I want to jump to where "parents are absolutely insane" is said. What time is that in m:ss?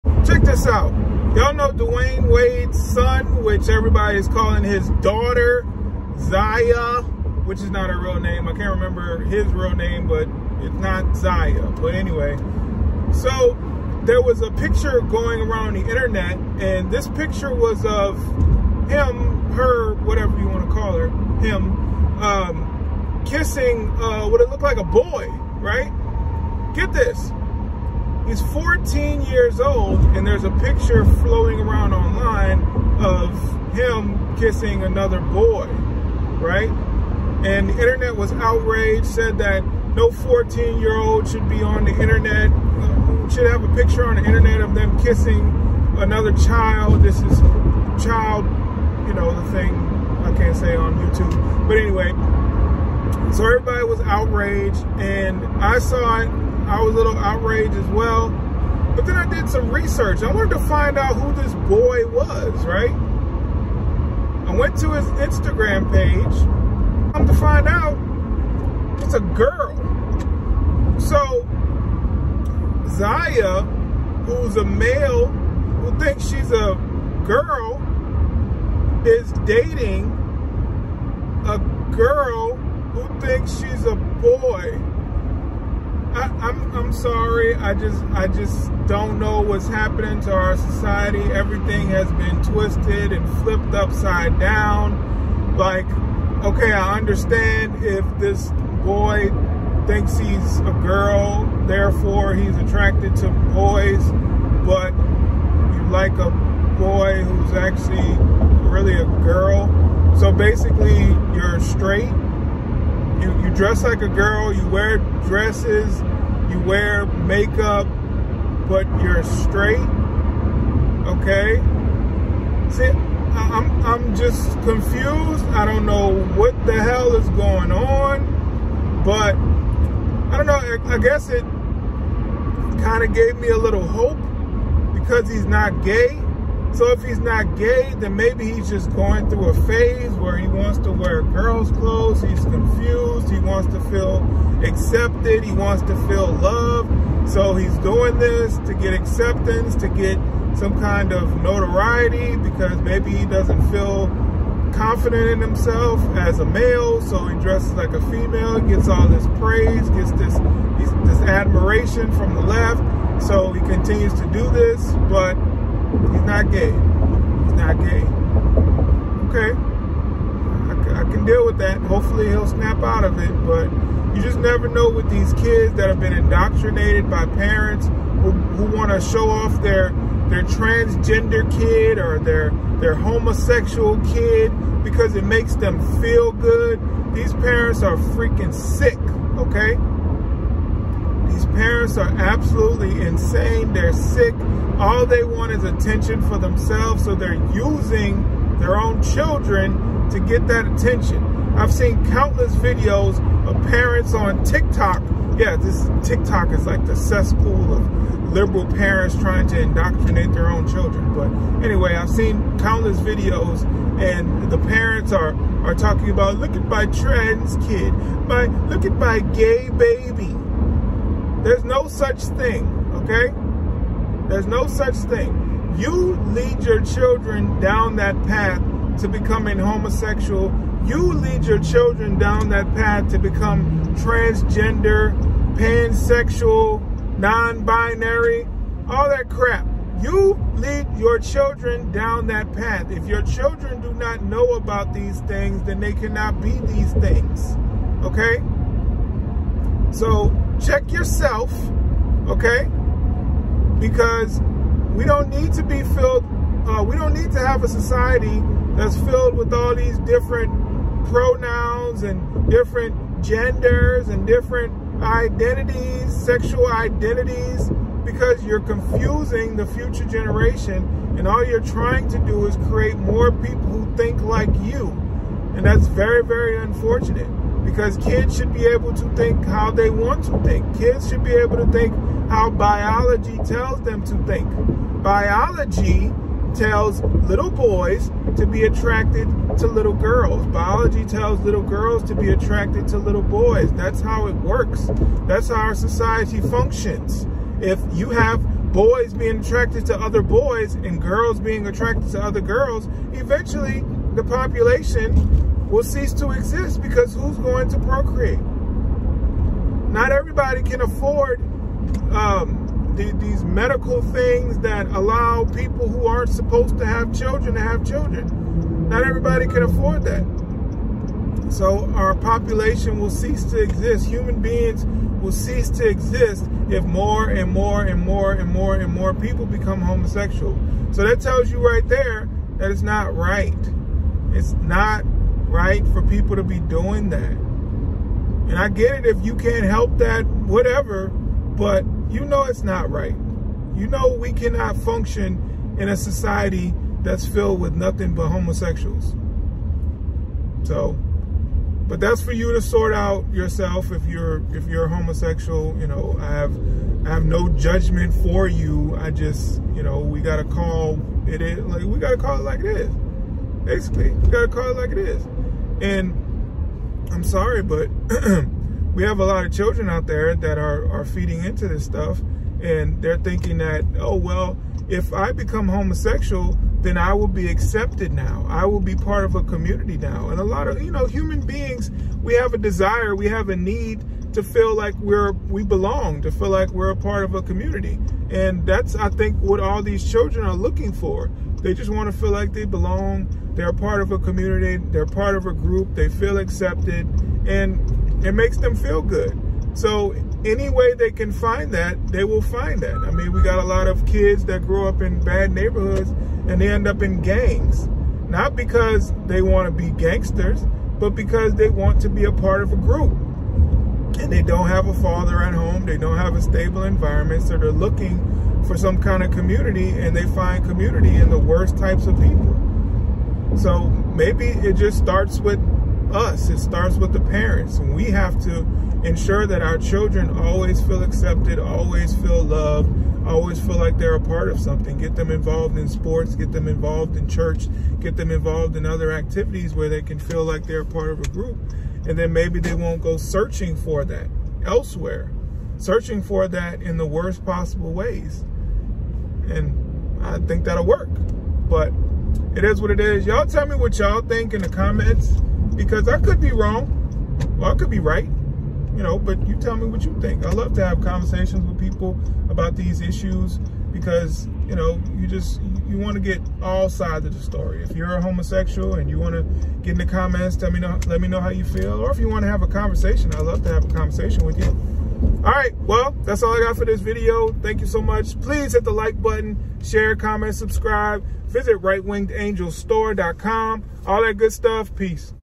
3:11.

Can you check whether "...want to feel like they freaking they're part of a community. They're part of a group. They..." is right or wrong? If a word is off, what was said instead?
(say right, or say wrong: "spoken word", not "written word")
wrong: "belong", not "freaking".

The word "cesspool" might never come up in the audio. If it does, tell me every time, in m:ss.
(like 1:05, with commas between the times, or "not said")
3:26.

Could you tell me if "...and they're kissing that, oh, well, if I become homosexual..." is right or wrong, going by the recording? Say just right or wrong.
wrong.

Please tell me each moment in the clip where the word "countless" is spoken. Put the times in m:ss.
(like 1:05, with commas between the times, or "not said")
3:22, 3:32.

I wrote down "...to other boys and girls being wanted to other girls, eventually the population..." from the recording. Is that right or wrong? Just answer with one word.
wrong.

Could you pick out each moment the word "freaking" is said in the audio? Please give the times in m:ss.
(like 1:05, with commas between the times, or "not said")
3:07.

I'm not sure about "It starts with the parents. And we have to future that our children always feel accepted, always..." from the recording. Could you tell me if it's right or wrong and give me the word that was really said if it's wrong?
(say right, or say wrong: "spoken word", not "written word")
wrong: "ensure", not "future".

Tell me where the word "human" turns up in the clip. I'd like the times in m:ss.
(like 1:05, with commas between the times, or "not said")
5:24, 6:21.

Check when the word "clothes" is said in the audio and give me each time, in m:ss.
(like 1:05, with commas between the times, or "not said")
2:21.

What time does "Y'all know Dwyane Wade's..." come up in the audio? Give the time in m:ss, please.
0:01.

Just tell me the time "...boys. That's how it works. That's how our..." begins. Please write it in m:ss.
4:53.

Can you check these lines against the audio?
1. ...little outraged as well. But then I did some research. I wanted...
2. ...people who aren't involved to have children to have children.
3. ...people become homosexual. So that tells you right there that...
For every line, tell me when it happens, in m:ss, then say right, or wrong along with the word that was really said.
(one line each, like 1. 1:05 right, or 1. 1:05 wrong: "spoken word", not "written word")
1. 0:56 right
2. 5:15 wrong: "supposed", not "involved"
3. 5:29 right.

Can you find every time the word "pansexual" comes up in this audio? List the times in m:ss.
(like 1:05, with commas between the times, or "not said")
3:55.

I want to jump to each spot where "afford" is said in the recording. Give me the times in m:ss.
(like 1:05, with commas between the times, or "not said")
5:10, 5:19.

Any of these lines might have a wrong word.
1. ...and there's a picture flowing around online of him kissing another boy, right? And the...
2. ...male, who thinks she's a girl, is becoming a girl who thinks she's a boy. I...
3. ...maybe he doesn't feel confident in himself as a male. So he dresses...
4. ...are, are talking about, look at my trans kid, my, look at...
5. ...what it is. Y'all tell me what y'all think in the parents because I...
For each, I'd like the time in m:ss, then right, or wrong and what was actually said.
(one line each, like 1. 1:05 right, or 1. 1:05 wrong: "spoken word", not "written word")
1. 0:30 right
2. 1:14 wrong: "dating", not "becoming"
3. 2:32 right
4. 3:35 right
5. 7:32 wrong: "comments", not "parents".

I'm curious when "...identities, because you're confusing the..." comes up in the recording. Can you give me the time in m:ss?
4:26.